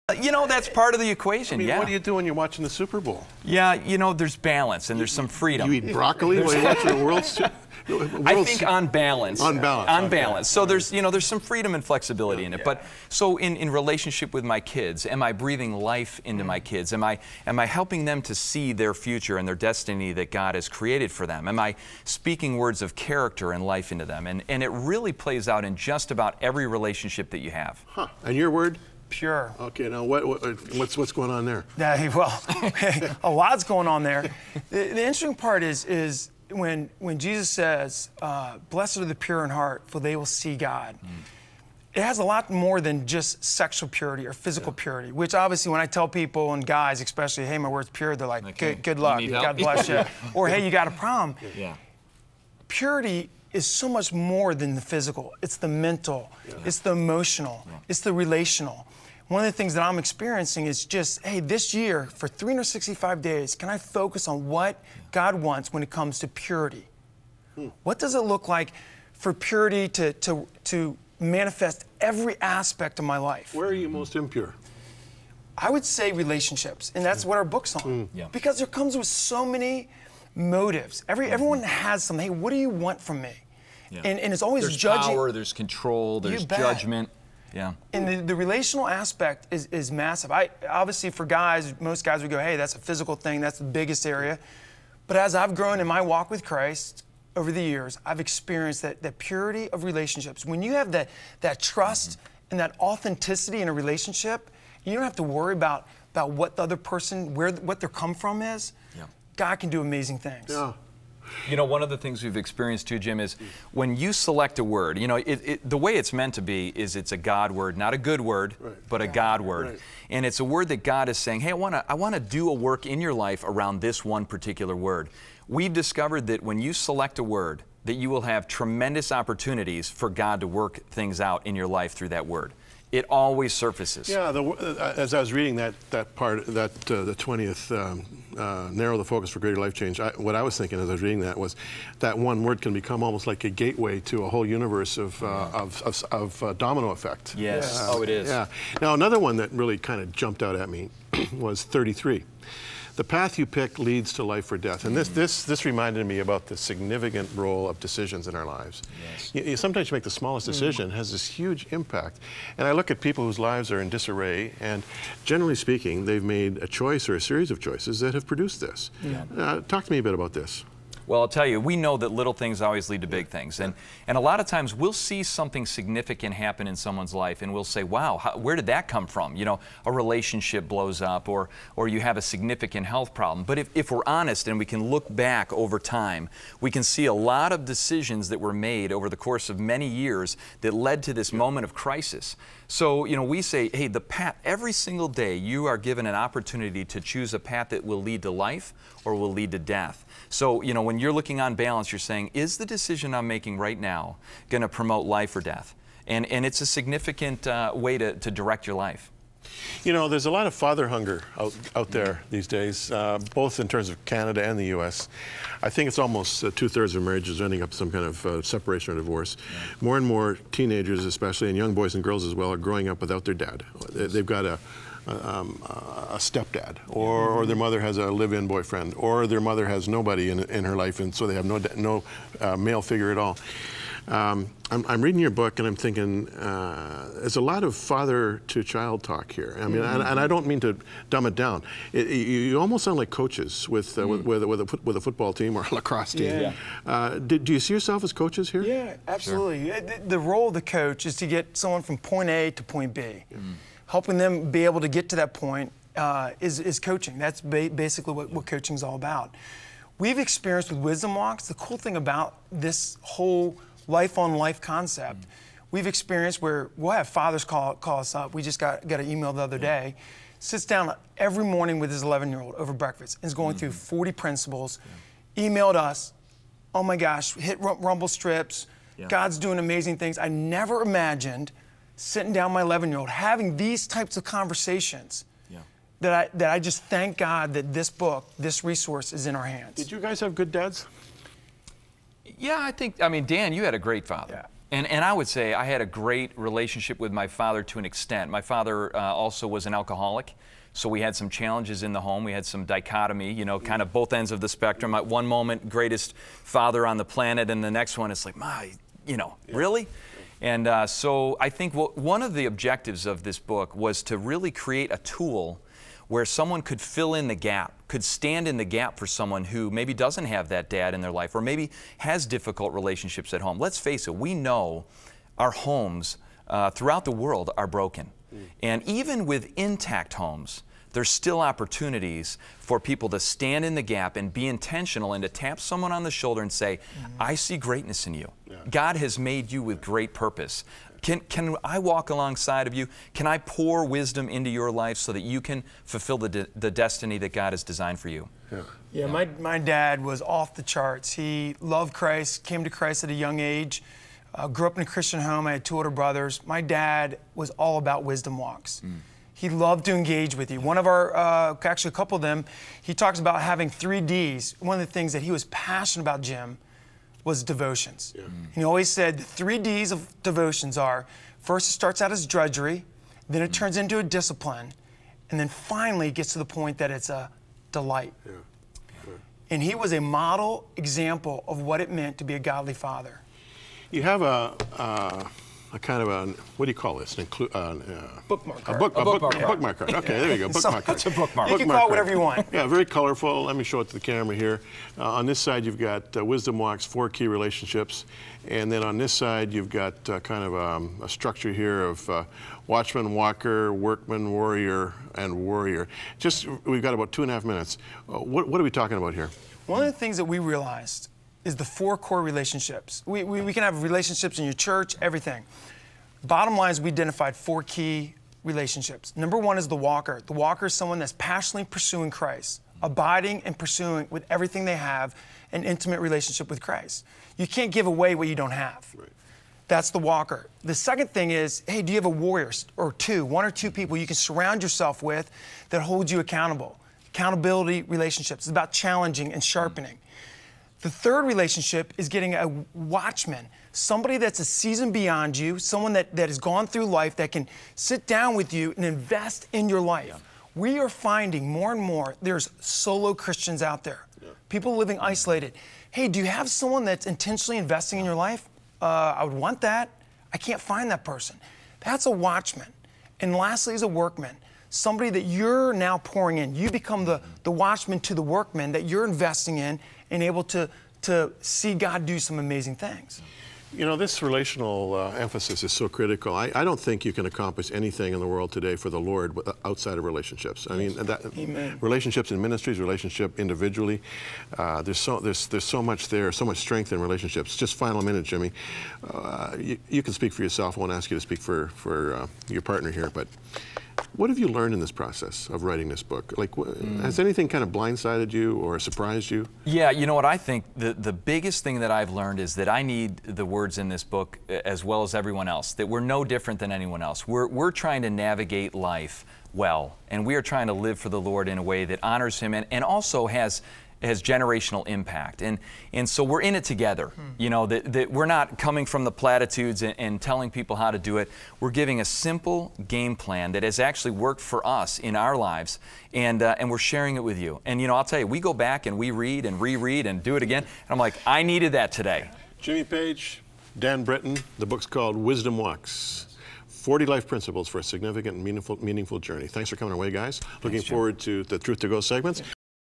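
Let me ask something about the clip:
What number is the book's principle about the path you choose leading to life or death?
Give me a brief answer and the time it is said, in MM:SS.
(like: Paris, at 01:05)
33, at 02:31.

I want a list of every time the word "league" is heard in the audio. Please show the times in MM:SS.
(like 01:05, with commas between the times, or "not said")
not said.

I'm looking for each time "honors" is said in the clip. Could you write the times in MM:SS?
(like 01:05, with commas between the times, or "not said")
08:32.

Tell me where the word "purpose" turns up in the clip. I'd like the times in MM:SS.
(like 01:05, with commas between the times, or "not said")
05:40.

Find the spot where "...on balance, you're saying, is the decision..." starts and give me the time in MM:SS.
03:21.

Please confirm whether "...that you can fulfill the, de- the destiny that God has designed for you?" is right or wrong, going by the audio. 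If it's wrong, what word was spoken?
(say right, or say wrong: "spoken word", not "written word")
right.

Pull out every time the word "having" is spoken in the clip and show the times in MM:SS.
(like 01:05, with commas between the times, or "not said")
04:43, 06:03.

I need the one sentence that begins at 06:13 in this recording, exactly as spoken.
turns into a discipline, and then finally it gets to the point that it's a delight.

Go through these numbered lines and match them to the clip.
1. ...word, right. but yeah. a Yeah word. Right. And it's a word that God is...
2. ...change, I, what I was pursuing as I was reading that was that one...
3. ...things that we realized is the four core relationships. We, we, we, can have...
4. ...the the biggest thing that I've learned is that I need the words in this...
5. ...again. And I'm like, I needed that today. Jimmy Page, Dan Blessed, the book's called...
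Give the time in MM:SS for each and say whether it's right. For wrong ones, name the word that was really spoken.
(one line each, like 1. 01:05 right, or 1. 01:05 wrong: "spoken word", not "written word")
1. 01:58 wrong: "God", not "Yeah"
2. 02:19 wrong: "thinking", not "pursuing"
3. 06:49 right
4. 08:20 right
5. 08:50 wrong: "Britton", not "Blessed".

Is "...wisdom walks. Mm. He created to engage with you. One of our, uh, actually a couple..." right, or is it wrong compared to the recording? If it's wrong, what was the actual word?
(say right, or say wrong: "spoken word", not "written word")
wrong: "loved", not "created".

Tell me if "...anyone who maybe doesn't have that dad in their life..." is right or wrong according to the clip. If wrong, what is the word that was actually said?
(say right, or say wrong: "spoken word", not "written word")
wrong: "someone", not "anyone".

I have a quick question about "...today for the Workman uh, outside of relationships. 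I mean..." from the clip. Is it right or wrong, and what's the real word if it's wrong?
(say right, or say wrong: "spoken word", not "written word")
wrong: "Lord", not "Workman".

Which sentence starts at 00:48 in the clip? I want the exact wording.
good, good luck, God bless you.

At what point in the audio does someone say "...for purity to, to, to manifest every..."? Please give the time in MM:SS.
01:09.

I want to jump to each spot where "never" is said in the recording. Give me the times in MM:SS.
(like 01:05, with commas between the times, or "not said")
04:40.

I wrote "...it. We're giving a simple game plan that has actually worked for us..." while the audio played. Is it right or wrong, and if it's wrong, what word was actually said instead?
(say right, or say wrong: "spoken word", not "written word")
right.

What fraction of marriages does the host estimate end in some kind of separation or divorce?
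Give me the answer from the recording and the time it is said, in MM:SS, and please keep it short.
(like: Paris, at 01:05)
two-thirds, at 03:36.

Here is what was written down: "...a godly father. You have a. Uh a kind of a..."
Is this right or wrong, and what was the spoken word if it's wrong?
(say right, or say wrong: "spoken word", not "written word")
right.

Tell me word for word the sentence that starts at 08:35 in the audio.
And, and so we're in it together.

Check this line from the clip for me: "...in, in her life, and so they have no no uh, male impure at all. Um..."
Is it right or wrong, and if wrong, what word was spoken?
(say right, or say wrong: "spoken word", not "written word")
wrong: "figure", not "impure".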